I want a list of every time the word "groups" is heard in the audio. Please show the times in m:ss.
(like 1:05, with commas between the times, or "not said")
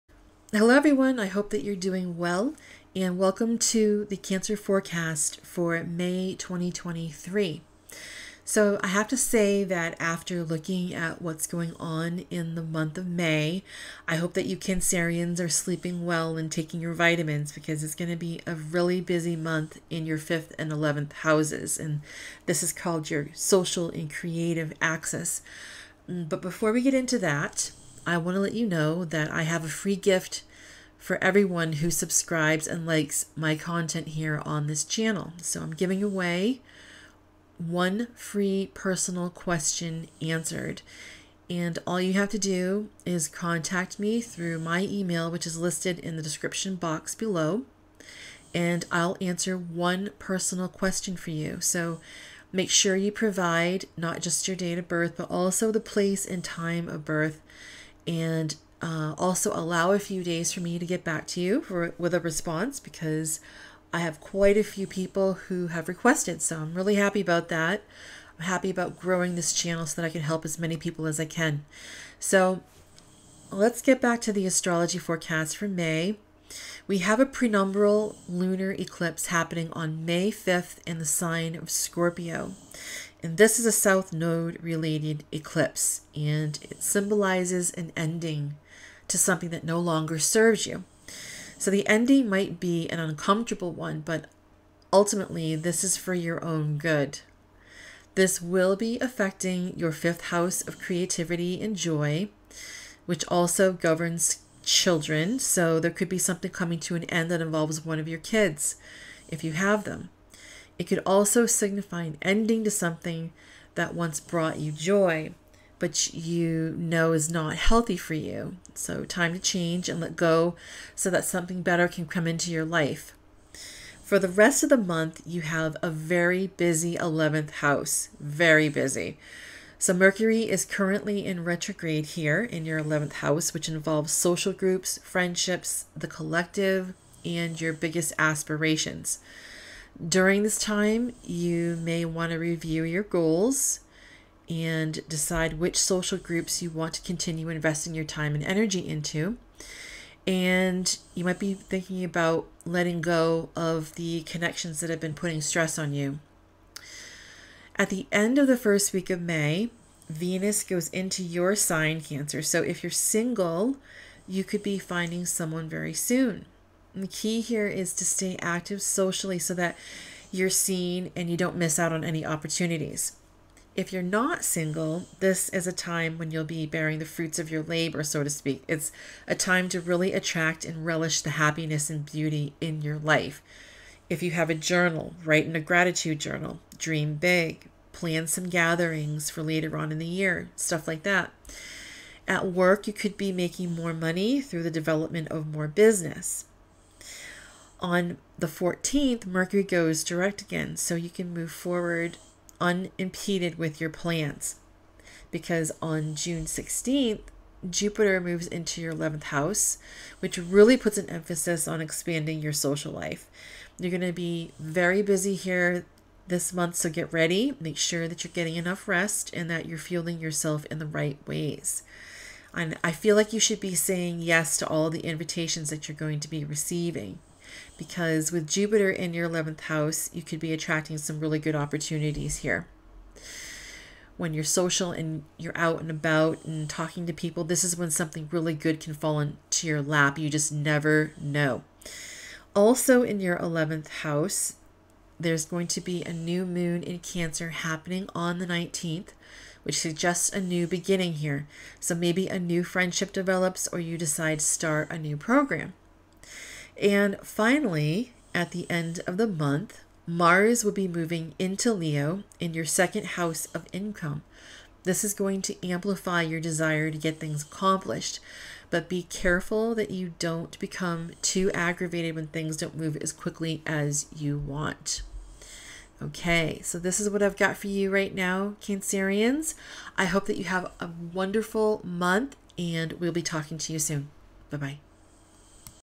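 2:14, 2:26.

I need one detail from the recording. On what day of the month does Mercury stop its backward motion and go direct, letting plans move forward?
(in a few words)
14th.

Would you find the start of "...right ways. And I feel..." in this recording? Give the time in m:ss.
3:40.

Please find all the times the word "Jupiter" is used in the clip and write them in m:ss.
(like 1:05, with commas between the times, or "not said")
3:27, 3:48.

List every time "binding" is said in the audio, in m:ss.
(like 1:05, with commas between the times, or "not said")
not said.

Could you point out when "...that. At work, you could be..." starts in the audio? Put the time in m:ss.
3:11.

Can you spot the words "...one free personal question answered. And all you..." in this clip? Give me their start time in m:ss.
0:37.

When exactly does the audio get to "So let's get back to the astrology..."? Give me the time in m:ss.
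1:12.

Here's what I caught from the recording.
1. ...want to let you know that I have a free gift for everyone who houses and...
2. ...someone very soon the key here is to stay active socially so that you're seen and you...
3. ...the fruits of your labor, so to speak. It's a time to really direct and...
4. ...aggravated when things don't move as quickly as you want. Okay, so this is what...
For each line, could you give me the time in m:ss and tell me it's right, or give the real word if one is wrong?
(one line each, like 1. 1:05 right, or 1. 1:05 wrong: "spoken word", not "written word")
1. 0:28 wrong: "subscribes", not "houses"
2. 2:45 right
3. 2:56 wrong: "attract", not "direct"
4. 4:31 right.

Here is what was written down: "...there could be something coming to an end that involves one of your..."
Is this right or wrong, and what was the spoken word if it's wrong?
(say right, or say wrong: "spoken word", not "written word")
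right.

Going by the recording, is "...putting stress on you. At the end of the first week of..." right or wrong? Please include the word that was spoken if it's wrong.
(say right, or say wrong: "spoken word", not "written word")
right.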